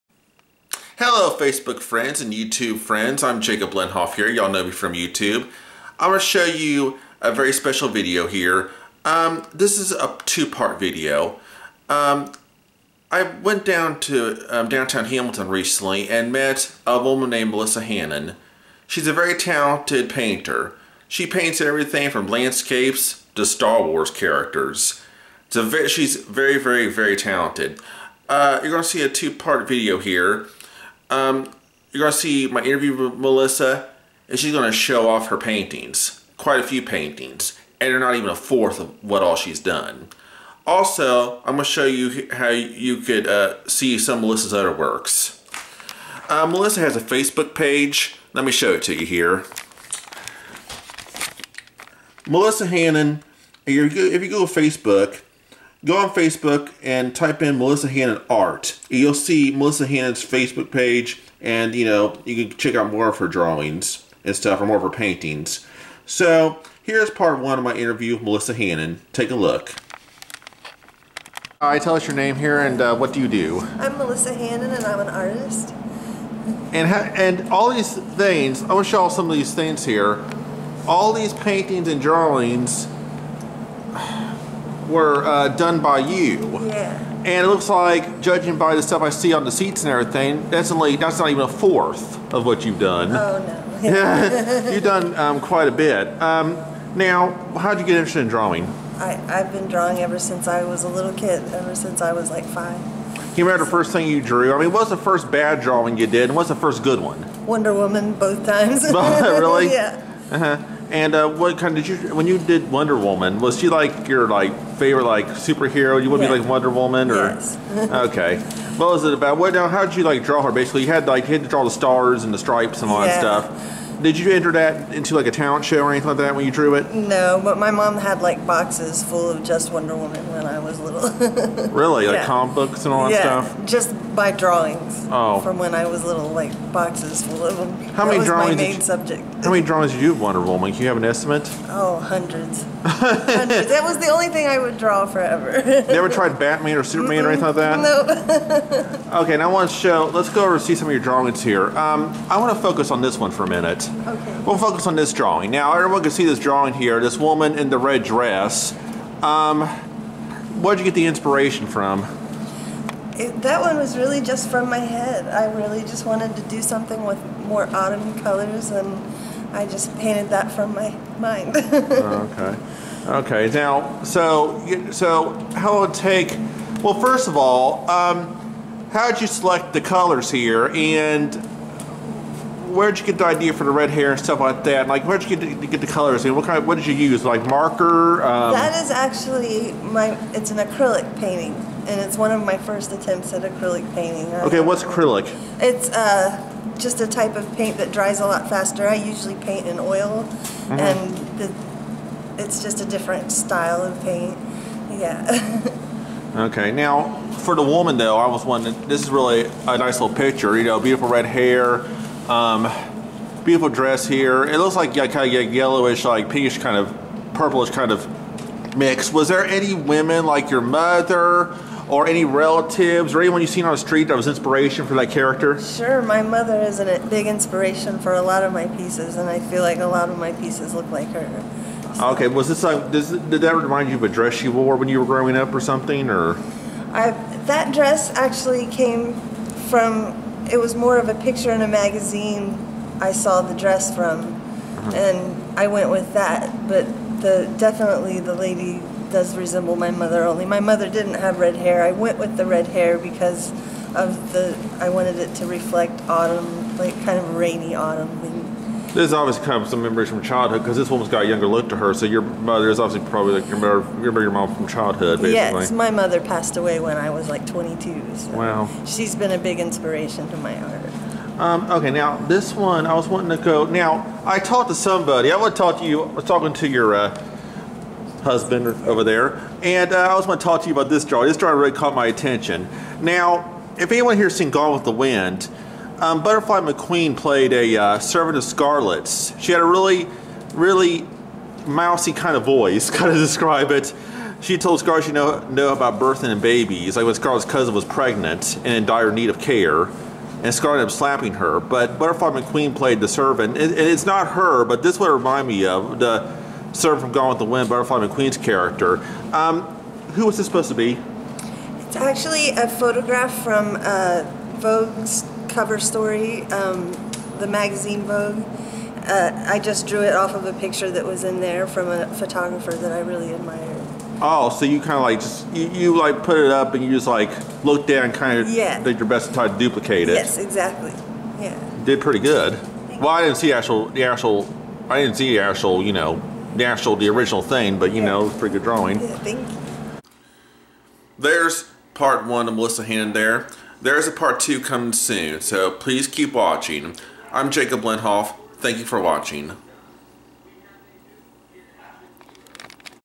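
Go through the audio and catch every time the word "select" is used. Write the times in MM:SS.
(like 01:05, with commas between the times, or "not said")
02:59.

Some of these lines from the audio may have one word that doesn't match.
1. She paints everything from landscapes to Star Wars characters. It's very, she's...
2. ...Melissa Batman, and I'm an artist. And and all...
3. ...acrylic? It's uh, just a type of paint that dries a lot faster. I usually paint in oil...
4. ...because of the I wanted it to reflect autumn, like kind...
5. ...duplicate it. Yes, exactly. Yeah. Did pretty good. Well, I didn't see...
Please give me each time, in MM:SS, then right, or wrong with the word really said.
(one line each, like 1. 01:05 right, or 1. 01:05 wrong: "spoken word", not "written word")
1. 00:21 right
2. 01:13 wrong: "Hannon", not "Batman"
3. 03:14 right
4. 04:12 right
5. 05:29 right.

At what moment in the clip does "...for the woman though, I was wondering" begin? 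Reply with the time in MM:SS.
03:27.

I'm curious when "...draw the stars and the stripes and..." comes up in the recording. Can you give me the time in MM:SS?
02:01.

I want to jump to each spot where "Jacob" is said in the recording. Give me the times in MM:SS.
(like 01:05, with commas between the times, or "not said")
00:03, 05:47.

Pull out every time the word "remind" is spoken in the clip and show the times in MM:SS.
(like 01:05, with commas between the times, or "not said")
03:53, 05:05.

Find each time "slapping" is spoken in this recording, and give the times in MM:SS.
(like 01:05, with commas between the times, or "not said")
05:00.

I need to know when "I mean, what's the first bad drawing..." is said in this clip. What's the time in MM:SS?
01:44.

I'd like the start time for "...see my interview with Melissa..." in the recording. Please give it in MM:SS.
00:32.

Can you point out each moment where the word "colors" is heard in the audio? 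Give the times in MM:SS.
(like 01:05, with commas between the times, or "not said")
02:48, 02:59, 03:05.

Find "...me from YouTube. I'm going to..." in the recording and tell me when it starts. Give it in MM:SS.
00:04.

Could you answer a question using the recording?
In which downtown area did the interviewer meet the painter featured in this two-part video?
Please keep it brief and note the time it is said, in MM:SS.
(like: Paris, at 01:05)
Hamilton, at 00:14.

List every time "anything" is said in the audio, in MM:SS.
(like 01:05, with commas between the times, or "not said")
02:05, 02:27.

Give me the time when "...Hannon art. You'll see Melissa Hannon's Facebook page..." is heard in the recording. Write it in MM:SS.
00:57.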